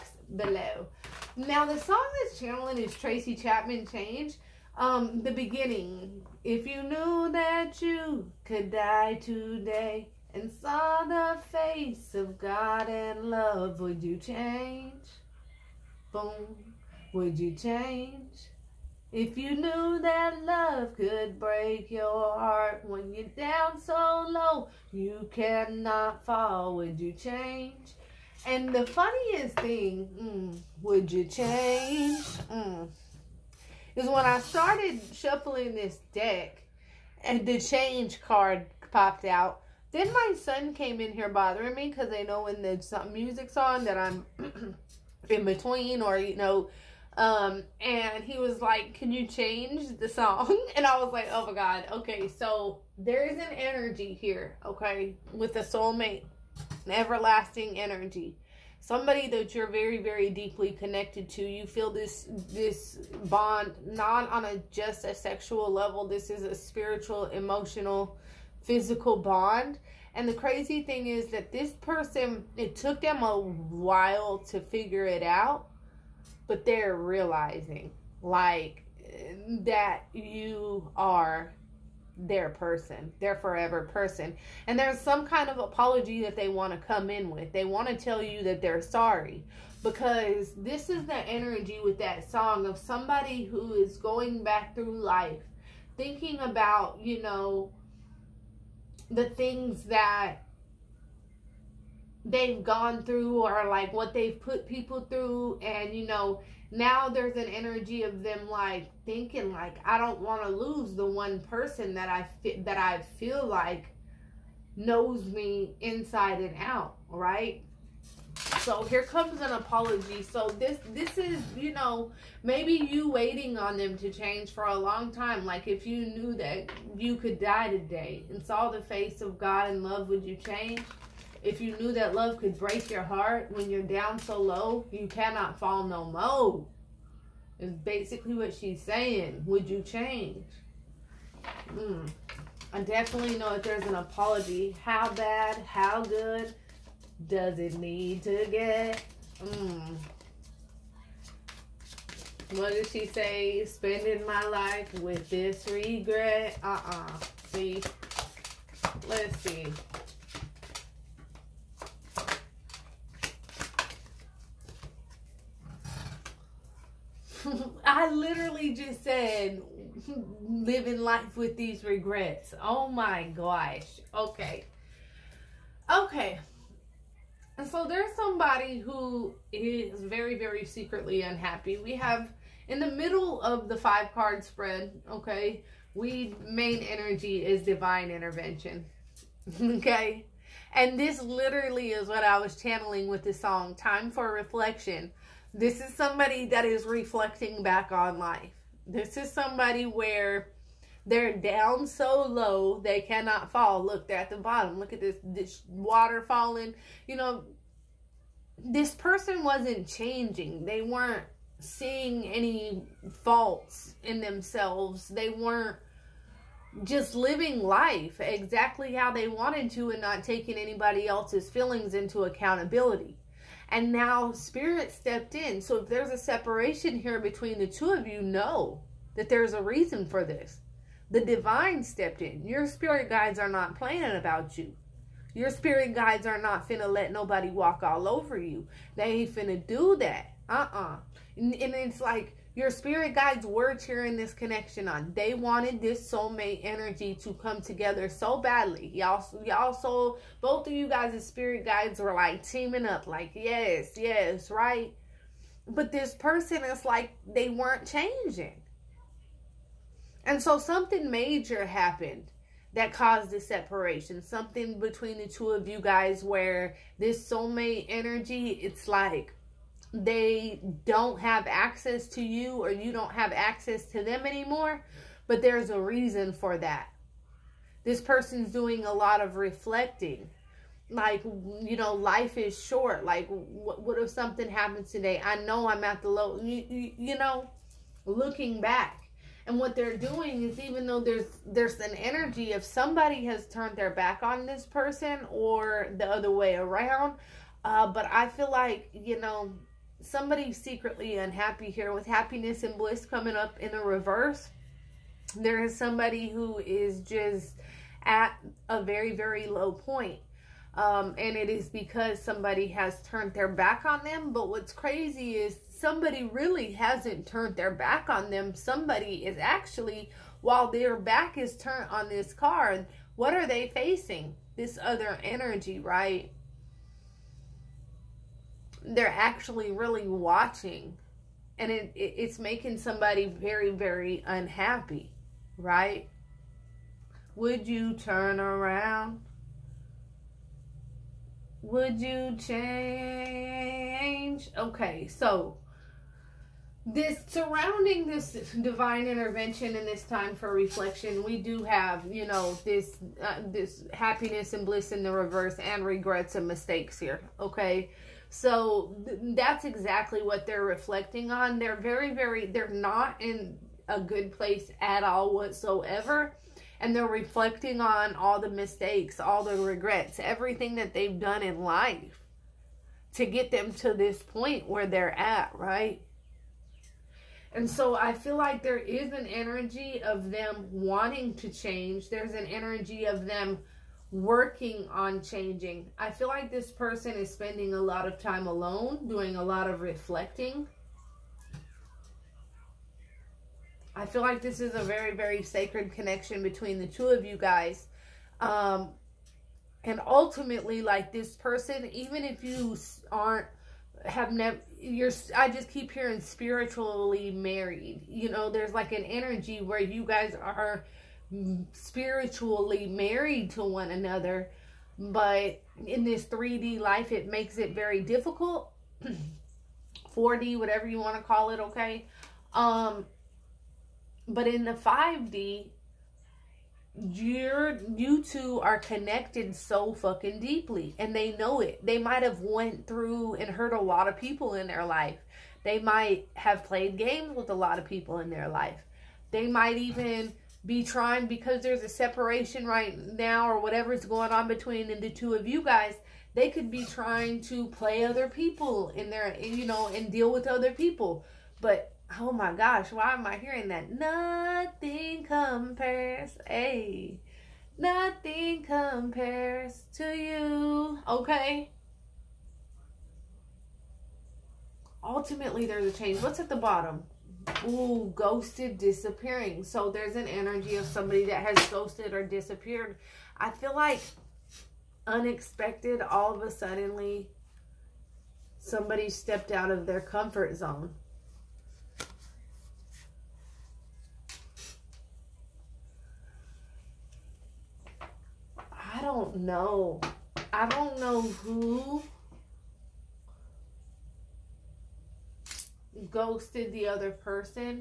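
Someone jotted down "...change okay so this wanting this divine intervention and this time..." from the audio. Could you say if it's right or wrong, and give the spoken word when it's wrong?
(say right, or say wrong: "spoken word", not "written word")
wrong: "surrounding", not "wanting".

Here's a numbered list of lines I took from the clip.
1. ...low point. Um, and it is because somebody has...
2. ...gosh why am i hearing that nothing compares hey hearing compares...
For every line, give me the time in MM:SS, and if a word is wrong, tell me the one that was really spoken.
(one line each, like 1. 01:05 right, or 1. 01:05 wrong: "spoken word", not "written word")
1. 05:09 right
2. 07:32 wrong: "nothing", not "hearing".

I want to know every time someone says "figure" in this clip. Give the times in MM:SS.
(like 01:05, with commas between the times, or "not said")
01:14.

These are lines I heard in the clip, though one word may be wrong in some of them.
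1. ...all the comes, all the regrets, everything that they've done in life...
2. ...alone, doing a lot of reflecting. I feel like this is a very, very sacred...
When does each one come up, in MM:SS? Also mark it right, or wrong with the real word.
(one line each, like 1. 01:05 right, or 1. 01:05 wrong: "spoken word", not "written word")
1. 06:08 wrong: "mistakes", not "comes"
2. 06:28 right.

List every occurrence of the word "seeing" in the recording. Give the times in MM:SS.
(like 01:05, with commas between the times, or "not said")
03:31.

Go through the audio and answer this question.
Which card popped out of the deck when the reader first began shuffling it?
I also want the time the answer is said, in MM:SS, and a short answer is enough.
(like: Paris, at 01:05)
Change card, at 00:37.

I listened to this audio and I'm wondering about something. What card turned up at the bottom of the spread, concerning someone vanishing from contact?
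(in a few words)
Ghosted, disappearing.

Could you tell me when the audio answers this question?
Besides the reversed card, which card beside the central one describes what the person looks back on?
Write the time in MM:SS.
05:55.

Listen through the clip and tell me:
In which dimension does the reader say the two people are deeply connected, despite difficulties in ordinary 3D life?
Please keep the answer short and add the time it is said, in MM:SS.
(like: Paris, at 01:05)
5D, at 07:04.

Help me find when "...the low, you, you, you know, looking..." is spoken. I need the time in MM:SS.
04:46.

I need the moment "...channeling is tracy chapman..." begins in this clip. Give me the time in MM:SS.
00:02.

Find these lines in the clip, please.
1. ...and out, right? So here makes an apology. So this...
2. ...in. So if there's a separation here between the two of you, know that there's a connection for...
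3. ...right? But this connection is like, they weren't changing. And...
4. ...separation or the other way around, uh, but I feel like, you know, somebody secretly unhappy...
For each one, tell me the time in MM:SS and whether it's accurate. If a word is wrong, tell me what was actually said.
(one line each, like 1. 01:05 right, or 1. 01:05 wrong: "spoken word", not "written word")
1. 01:56 wrong: "comes", not "makes"
2. 03:45 wrong: "reason", not "connection"
3. 04:14 wrong: "person", not "connection"
4. 04:54 wrong: "person", not "separation".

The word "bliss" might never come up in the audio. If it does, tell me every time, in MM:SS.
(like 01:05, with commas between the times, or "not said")
05:02, 05:54.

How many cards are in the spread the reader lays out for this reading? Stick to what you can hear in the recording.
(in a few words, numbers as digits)
5.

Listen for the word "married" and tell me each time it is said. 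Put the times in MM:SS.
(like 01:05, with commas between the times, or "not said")
06:47, 06:52.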